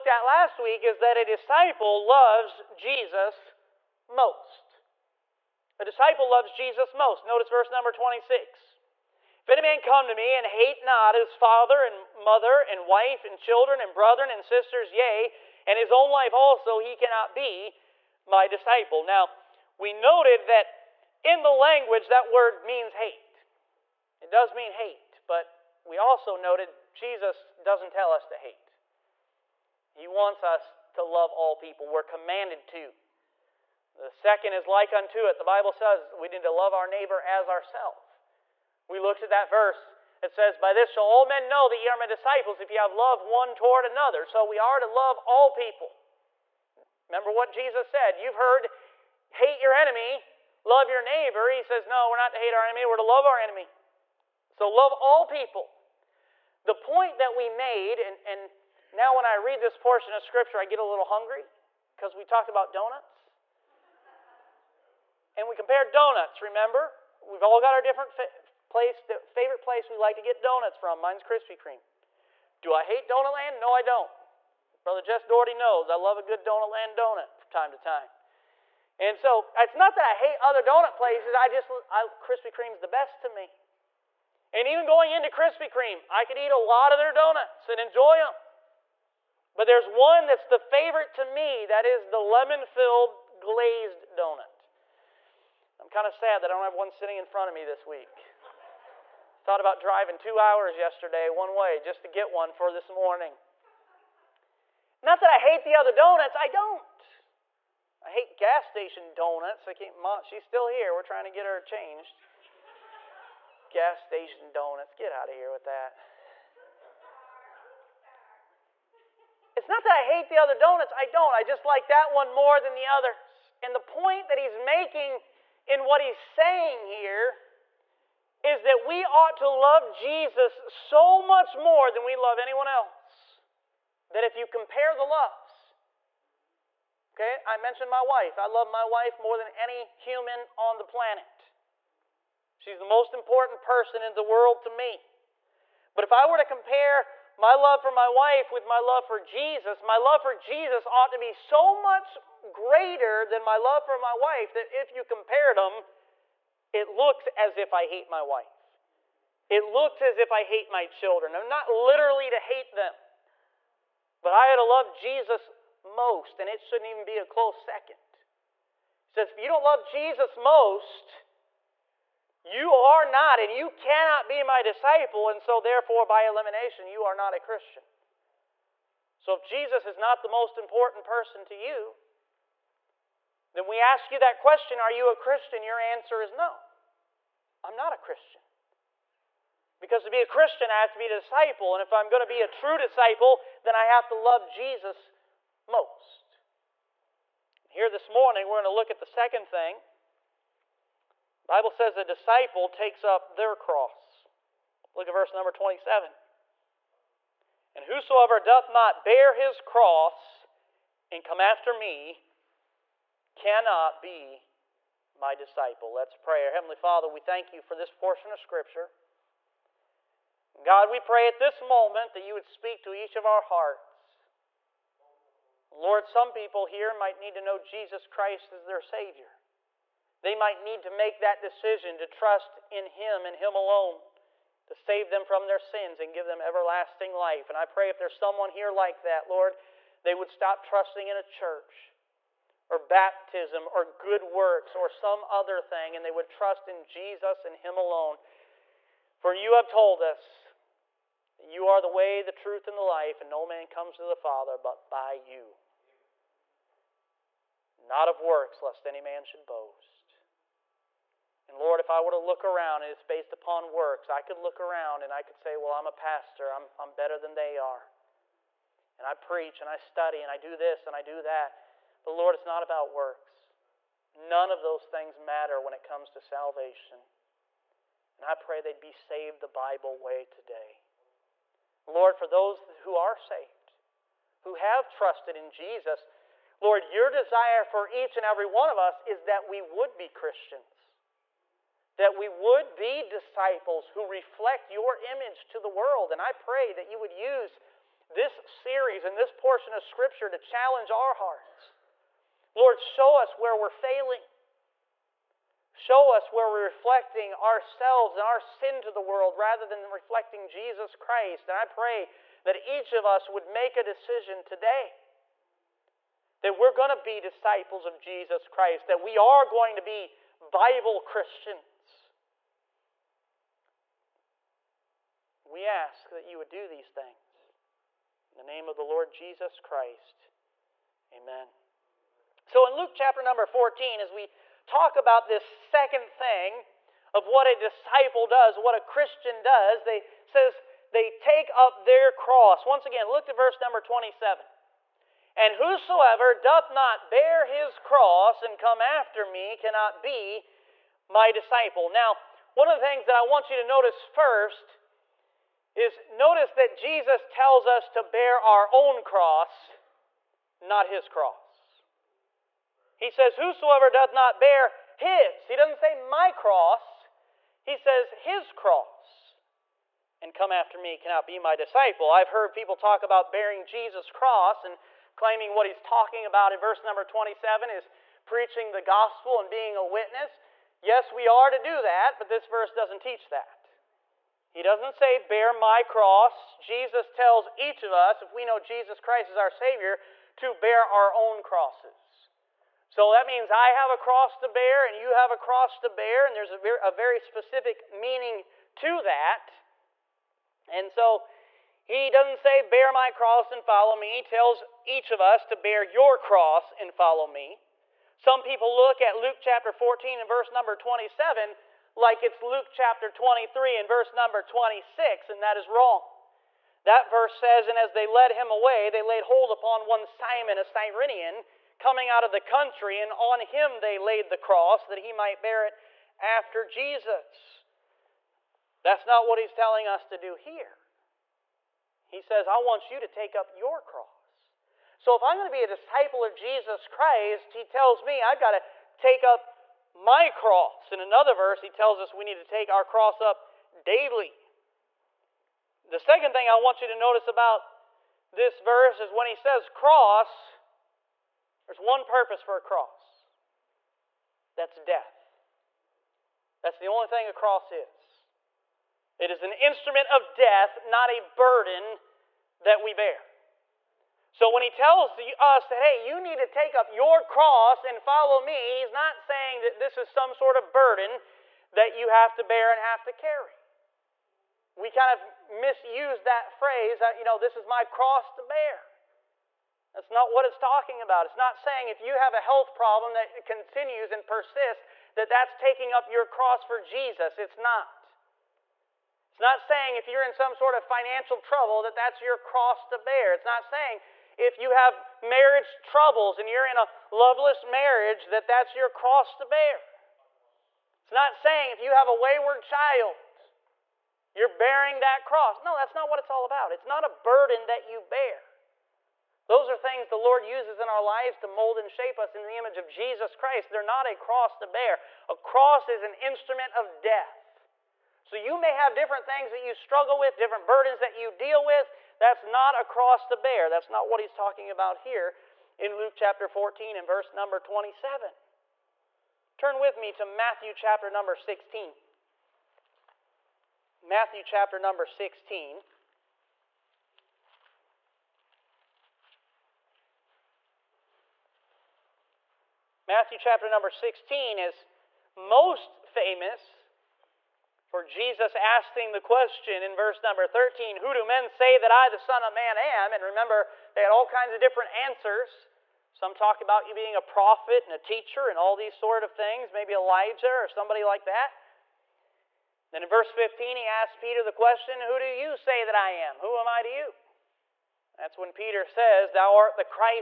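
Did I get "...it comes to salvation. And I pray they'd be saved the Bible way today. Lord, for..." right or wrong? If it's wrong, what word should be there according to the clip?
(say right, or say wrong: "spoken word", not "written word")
right.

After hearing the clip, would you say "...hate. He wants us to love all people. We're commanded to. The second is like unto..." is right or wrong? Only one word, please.
right.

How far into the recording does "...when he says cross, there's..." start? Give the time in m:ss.
7:29.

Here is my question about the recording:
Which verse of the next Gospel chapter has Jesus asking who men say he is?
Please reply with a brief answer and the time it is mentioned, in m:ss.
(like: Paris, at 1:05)
13, at 9:09.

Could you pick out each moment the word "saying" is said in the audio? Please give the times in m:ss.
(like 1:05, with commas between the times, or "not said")
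2:06, 7:49, 8:01, 8:09, 8:13, 8:21.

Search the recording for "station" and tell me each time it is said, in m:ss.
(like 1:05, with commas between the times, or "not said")
1:48, 1:54.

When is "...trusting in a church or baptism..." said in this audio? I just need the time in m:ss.
4:00.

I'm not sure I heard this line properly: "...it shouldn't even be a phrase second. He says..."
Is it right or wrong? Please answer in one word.
wrong.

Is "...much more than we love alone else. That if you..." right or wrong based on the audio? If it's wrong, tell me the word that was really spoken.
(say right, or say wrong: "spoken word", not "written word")
wrong: "anyone", not "alone".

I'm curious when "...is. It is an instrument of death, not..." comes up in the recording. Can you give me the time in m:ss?
7:37.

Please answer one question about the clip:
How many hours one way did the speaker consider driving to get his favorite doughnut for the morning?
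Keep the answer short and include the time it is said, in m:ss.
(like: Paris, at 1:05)
2, at 1:40.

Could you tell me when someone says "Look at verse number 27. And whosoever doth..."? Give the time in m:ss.
3:24.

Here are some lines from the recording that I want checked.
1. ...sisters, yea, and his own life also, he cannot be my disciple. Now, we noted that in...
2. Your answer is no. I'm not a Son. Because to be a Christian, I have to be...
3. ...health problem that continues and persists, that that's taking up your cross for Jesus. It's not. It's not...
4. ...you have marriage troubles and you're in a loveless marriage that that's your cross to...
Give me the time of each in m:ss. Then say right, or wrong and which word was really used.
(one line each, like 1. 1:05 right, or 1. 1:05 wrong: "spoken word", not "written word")
1. 0:14 right
2. 3:05 wrong: "Christian", not "Son"
3. 8:02 right
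4. 8:14 right.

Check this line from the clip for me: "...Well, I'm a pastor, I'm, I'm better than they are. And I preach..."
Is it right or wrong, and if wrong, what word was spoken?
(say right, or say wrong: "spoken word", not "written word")
right.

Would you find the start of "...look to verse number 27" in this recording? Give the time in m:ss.
5:43.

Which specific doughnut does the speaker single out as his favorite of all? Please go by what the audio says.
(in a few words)
lemon filled glazed.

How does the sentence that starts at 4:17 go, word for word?
Not of works, lest any man should boast.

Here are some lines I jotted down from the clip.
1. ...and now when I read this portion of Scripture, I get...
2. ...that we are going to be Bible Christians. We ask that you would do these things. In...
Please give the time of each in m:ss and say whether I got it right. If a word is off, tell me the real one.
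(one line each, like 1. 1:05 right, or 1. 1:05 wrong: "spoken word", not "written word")
1. 0:58 right
2. 5:18 right.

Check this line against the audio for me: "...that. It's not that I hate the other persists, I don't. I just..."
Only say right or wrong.
wrong.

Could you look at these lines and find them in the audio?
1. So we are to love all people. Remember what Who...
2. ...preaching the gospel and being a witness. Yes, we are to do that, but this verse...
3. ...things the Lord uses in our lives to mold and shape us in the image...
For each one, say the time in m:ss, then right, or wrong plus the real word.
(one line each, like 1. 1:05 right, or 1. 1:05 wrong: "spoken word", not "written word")
1. 0:44 wrong: "Jesus", not "Who"
2. 6:18 right
3. 8:29 right.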